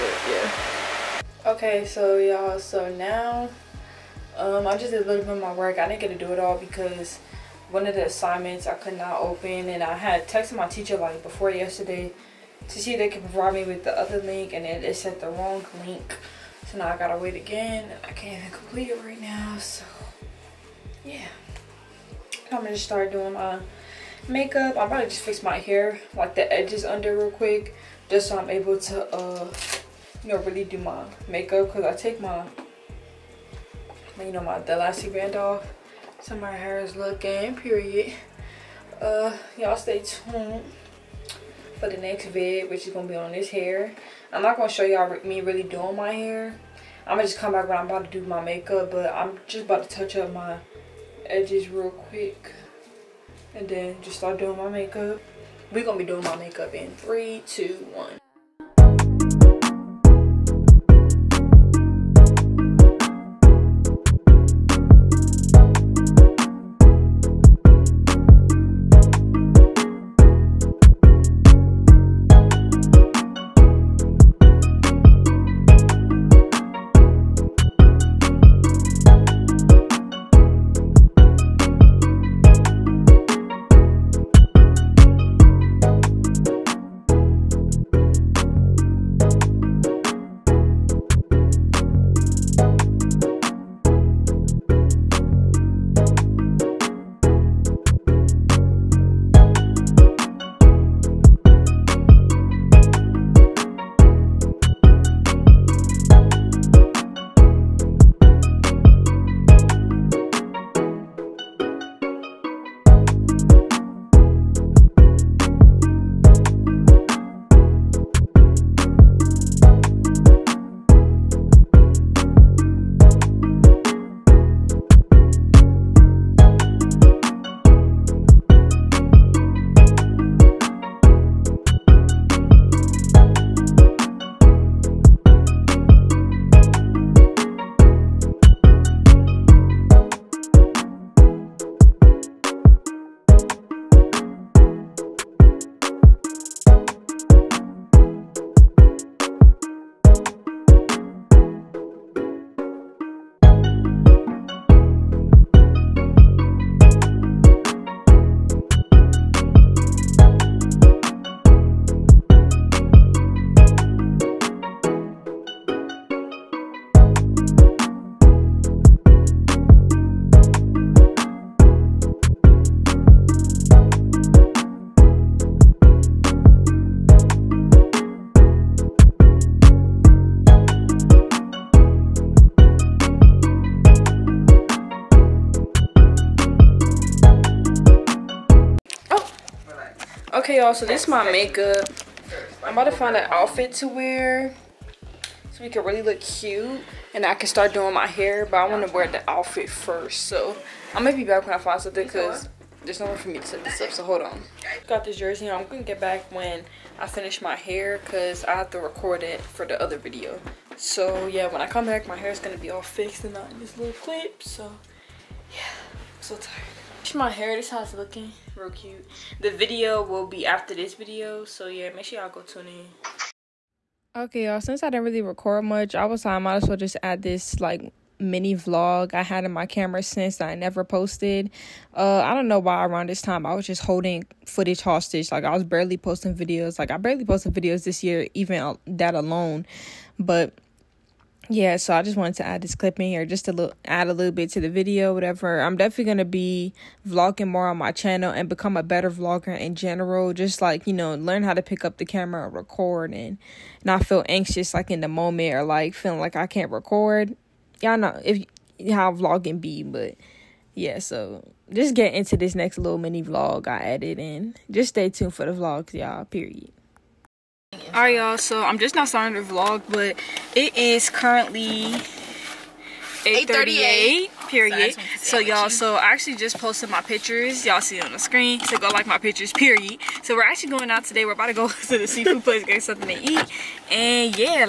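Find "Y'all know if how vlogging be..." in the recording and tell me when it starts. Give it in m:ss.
4:17.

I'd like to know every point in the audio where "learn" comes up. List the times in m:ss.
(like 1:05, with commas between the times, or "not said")
4:11.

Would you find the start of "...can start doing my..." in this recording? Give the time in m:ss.
3:17.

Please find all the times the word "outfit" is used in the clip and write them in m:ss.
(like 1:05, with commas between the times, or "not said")
3:13, 3:19.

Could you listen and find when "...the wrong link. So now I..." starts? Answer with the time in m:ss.
0:15.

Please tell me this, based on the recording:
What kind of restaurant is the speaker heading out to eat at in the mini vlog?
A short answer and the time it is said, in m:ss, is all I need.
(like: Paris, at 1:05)
seafood place, at 4:42.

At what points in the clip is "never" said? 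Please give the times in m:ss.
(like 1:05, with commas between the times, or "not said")
3:50.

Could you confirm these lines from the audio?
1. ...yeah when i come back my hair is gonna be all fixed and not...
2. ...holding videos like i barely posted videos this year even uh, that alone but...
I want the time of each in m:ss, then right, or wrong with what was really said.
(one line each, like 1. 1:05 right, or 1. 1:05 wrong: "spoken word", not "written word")
1. 3:31 right
2. 3:55 wrong: "posting", not "holding".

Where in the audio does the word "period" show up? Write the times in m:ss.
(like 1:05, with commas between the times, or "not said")
0:37, 4:26, 4:34, 4:39.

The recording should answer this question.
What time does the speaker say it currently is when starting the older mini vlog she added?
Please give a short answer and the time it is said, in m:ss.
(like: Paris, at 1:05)
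8:38, at 4:33.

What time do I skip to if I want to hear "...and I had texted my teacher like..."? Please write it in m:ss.
0:09.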